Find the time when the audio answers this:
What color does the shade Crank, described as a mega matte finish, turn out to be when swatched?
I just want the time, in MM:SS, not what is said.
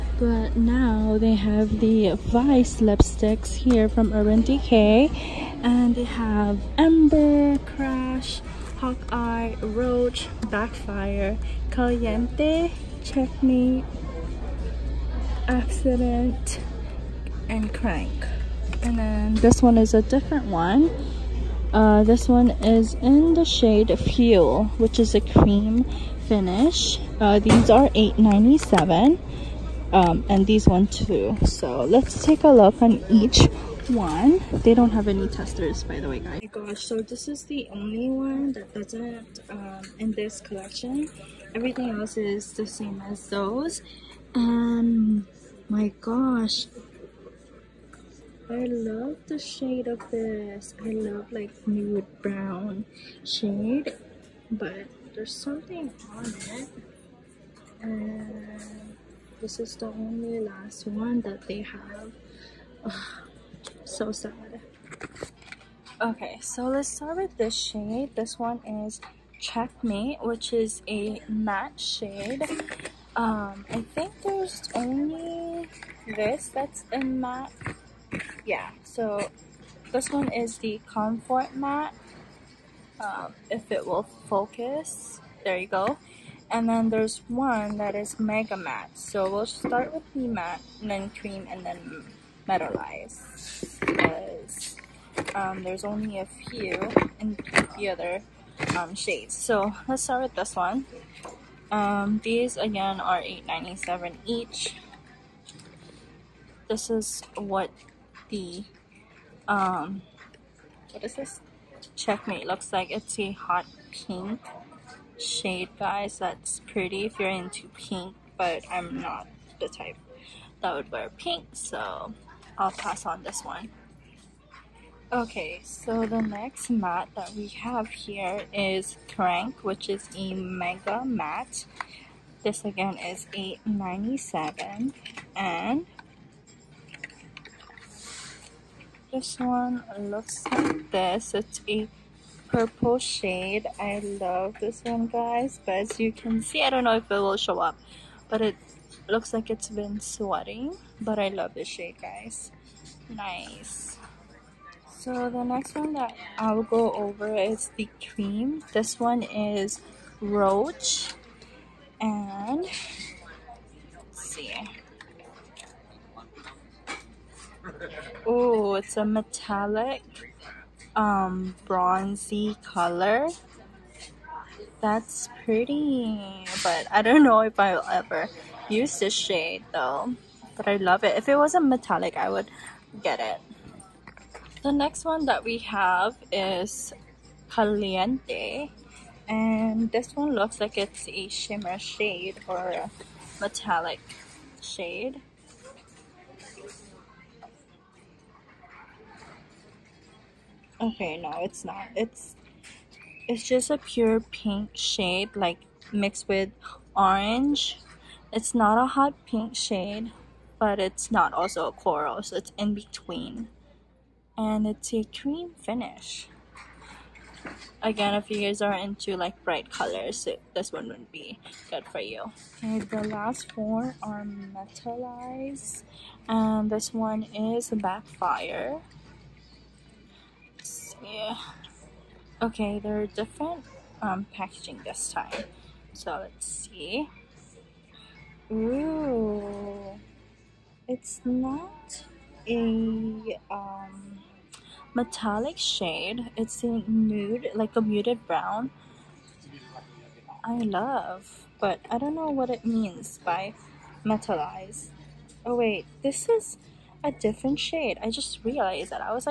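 02:22.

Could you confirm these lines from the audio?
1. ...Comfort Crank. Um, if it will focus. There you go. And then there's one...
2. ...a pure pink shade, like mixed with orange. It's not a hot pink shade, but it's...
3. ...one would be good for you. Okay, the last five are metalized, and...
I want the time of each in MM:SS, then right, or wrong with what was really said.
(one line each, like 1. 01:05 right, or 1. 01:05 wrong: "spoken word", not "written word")
1. 01:20 wrong: "Matte", not "Crank"
2. 03:23 right
3. 03:40 wrong: "four", not "five".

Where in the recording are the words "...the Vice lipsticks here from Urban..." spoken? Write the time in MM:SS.
00:01.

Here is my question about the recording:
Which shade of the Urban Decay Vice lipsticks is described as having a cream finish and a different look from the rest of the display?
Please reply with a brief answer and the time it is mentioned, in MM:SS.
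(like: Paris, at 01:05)
Fuel, at 00:23.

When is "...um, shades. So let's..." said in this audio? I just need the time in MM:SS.
01:38.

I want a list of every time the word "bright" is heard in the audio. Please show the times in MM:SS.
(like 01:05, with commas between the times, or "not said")
03:39.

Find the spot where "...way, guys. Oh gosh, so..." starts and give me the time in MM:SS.
00:36.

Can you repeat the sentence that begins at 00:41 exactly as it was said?
Everything else is the same as those.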